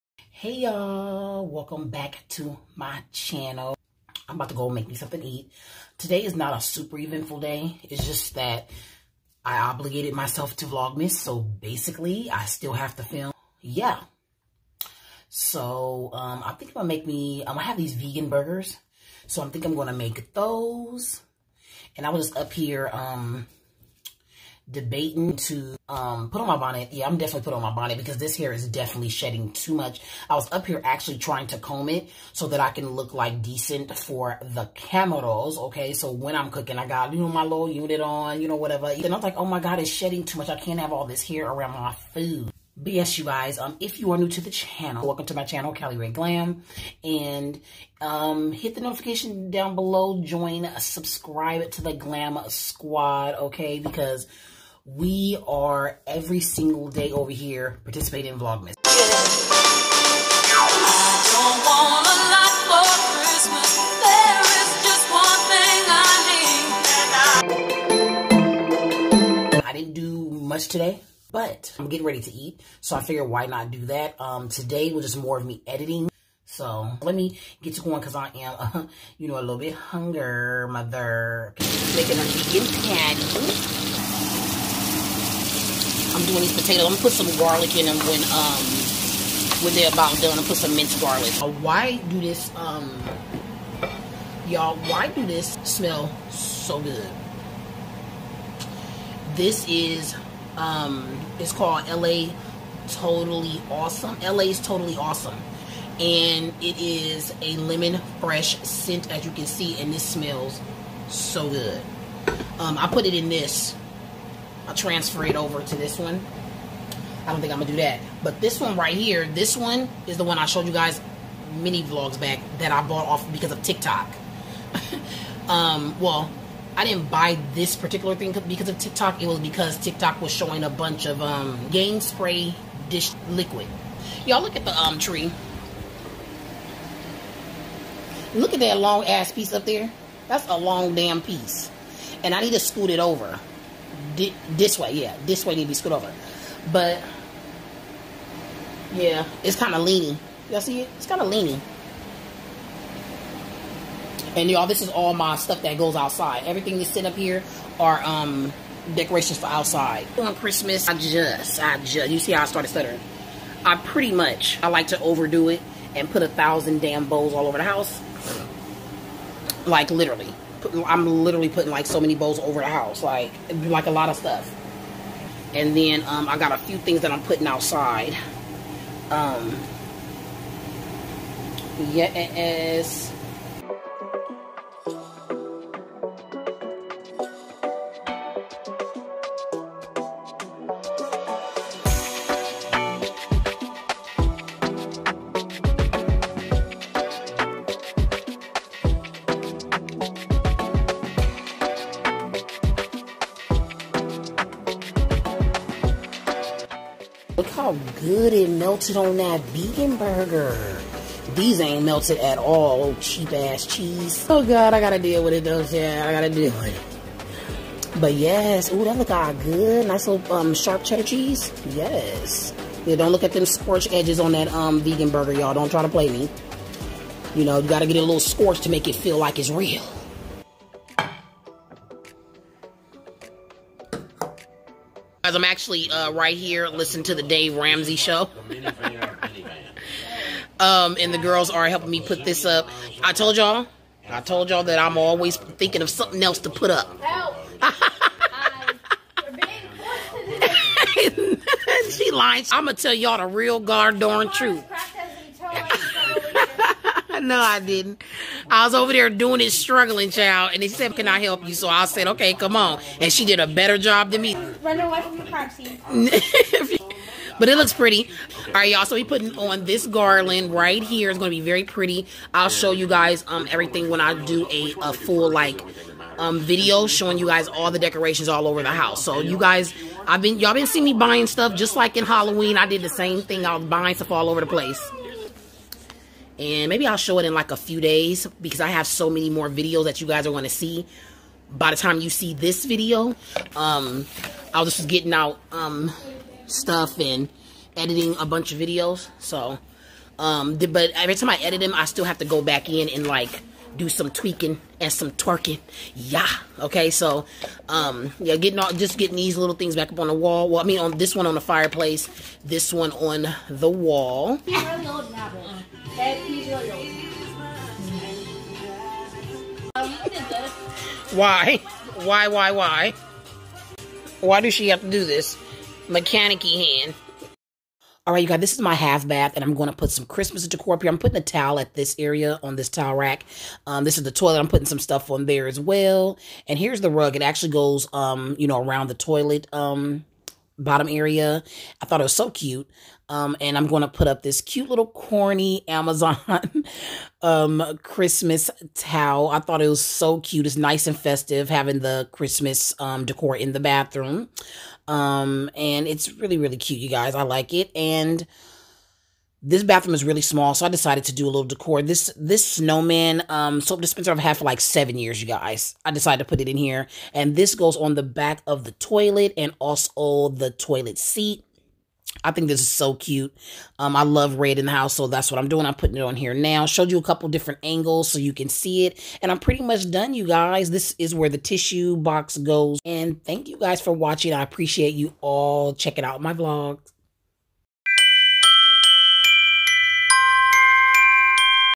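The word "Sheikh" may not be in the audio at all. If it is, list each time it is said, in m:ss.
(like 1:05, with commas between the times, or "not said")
not said.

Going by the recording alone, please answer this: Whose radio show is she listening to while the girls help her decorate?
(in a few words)
Dave Ramsey.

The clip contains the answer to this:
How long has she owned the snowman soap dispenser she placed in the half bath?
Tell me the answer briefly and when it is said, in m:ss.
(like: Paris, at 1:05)
7 years, at 6:04.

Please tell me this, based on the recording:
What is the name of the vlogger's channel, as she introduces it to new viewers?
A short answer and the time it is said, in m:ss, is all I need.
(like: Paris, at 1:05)
Cali Redd Glam, at 0:45.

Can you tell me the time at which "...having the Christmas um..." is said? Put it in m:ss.
5:51.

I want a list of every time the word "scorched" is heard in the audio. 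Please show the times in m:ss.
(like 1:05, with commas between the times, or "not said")
3:43, 3:48.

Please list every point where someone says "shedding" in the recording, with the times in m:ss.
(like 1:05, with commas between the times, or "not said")
0:29, 0:39.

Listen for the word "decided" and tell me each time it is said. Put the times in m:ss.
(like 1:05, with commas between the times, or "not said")
6:00, 6:05.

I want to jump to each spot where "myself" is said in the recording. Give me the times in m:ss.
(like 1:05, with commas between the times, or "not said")
0:10.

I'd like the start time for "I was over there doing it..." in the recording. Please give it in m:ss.
4:18.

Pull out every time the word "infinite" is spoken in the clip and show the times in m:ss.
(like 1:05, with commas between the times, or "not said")
not said.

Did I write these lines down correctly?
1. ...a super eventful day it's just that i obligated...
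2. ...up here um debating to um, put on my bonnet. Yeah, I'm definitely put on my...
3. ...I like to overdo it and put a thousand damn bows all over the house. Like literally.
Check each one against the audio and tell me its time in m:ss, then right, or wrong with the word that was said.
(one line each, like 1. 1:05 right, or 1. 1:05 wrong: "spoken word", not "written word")
1. 0:06 right
2. 0:22 right
3. 2:44 right.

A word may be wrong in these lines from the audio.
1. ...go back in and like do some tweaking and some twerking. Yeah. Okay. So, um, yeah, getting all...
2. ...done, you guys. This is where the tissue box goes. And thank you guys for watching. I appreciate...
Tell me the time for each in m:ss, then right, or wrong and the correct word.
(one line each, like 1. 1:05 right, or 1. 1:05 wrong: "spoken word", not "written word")
1. 5:02 right
2. 6:19 right.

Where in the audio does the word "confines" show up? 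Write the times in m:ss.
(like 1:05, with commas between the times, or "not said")
not said.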